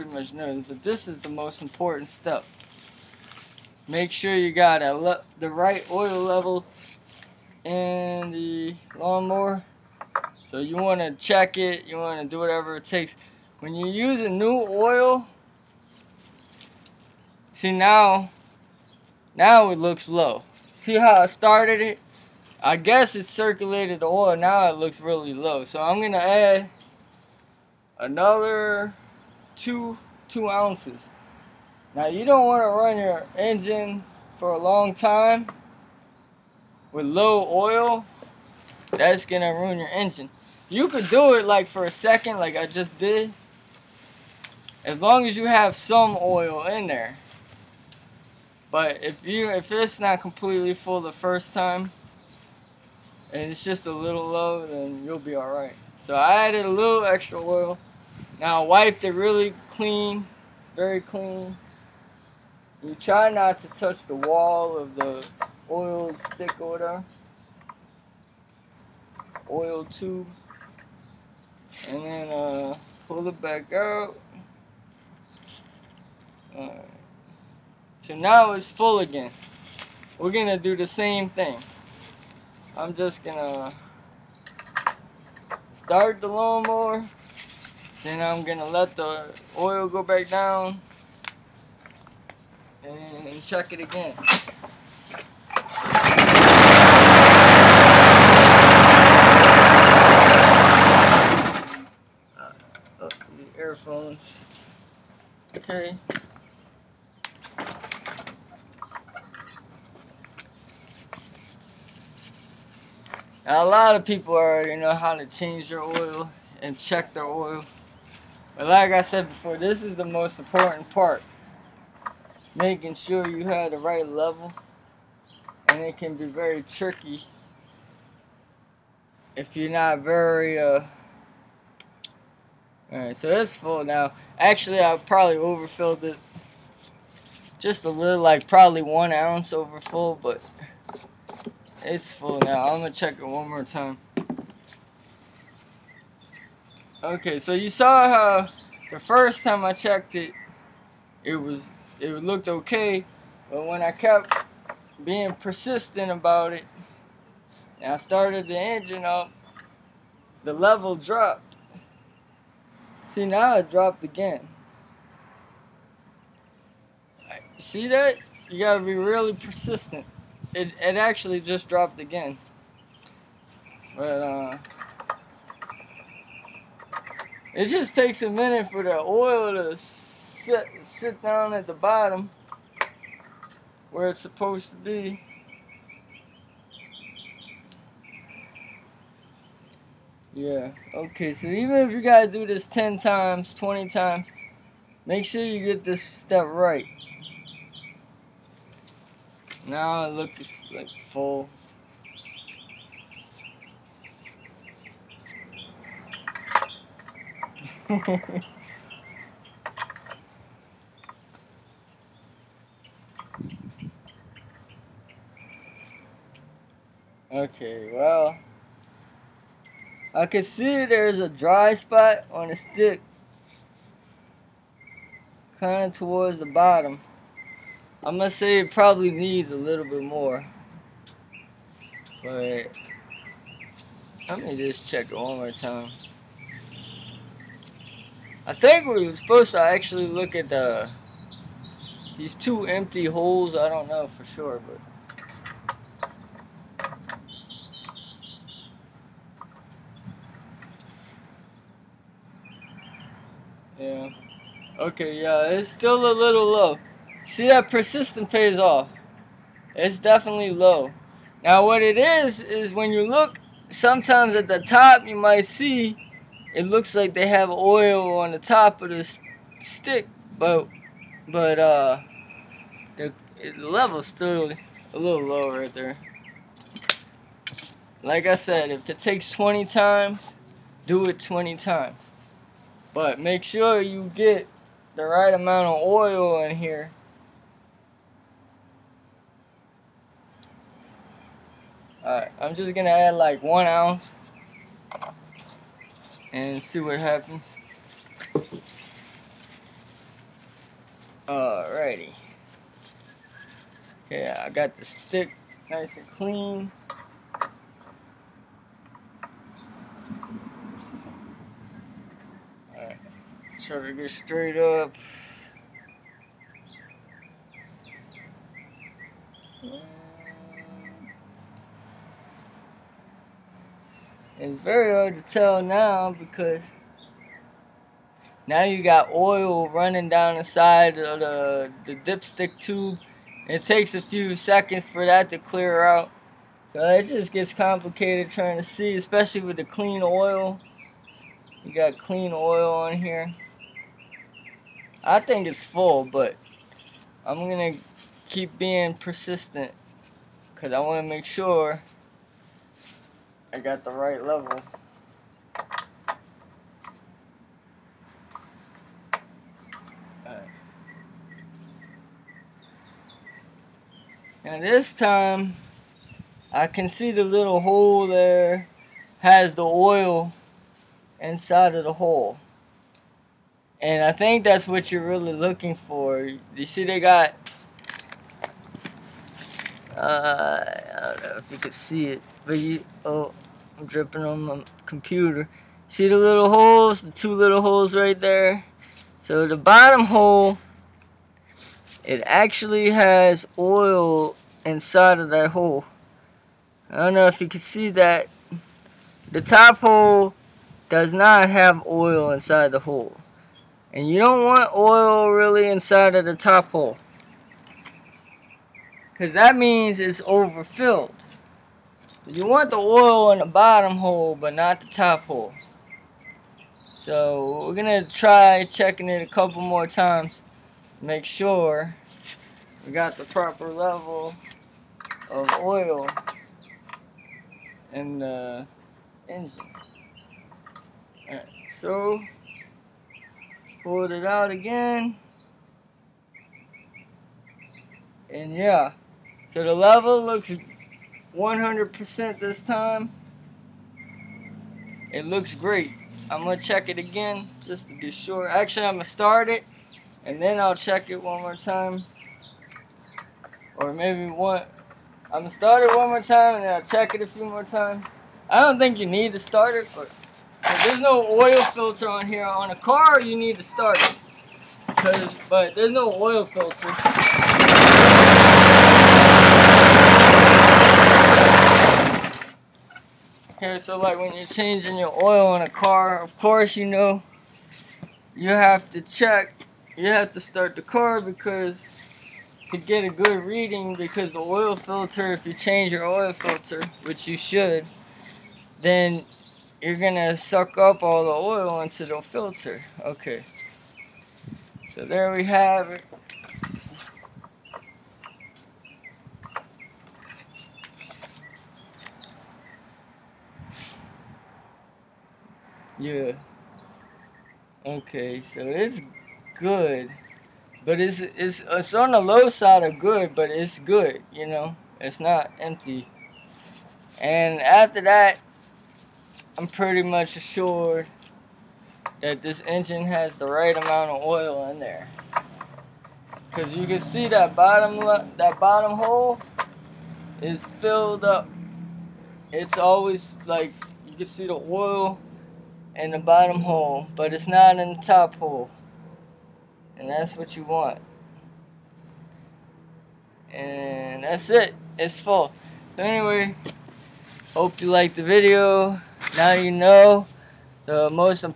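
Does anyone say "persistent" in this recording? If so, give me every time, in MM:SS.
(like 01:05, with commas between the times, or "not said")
02:35, 02:49, 04:17, 05:48.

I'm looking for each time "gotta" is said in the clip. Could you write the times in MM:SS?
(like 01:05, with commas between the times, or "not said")
02:48, 03:11.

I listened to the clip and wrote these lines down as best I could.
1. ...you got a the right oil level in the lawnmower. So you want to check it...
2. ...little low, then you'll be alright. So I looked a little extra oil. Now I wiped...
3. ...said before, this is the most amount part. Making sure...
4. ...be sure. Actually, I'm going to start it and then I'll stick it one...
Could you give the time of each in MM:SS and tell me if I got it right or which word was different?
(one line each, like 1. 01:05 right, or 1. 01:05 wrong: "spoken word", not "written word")
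1. 00:04 right
2. 00:53 wrong: "added", not "looked"
3. 01:59 wrong: "important", not "amount"
4. 07:27 wrong: "check", not "stick".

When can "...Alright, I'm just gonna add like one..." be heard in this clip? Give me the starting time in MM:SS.
04:52.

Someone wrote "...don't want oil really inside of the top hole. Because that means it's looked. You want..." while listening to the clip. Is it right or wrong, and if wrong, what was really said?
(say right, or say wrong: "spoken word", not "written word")
wrong: "overfilled", not "looked".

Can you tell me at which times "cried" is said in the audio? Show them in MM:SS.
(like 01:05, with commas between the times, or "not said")
not said.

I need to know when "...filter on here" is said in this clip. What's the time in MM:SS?
07:41.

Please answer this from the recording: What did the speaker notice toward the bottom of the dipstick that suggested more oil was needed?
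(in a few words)
a dry spot.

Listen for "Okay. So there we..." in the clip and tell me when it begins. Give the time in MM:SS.
08:13.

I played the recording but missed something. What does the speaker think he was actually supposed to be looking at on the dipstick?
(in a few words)
two empty holes.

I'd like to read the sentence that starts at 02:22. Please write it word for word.
I'm gonna check it one more time.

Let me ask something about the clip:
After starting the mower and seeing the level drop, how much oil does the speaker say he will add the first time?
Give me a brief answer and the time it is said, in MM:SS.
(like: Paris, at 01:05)
2 ounces, at 00:30.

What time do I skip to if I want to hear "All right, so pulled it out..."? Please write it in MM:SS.
07:11.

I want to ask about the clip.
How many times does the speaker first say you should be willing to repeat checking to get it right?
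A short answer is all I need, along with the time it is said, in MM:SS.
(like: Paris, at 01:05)
10 times, 20 times, at 03:12.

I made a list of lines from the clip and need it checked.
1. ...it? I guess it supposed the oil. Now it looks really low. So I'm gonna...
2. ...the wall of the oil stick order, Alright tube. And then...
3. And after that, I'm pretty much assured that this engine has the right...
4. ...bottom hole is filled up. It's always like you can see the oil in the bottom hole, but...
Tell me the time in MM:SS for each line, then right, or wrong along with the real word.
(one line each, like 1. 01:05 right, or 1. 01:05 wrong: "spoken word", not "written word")
1. 00:21 wrong: "circulated", not "supposed"
2. 01:04 wrong: "Oil", not "Alright"
3. 08:37 right
4. 08:48 right.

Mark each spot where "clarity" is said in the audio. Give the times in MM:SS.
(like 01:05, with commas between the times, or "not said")
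not said.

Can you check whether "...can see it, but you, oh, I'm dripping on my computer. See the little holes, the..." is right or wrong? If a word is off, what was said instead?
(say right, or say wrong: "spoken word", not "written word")
right.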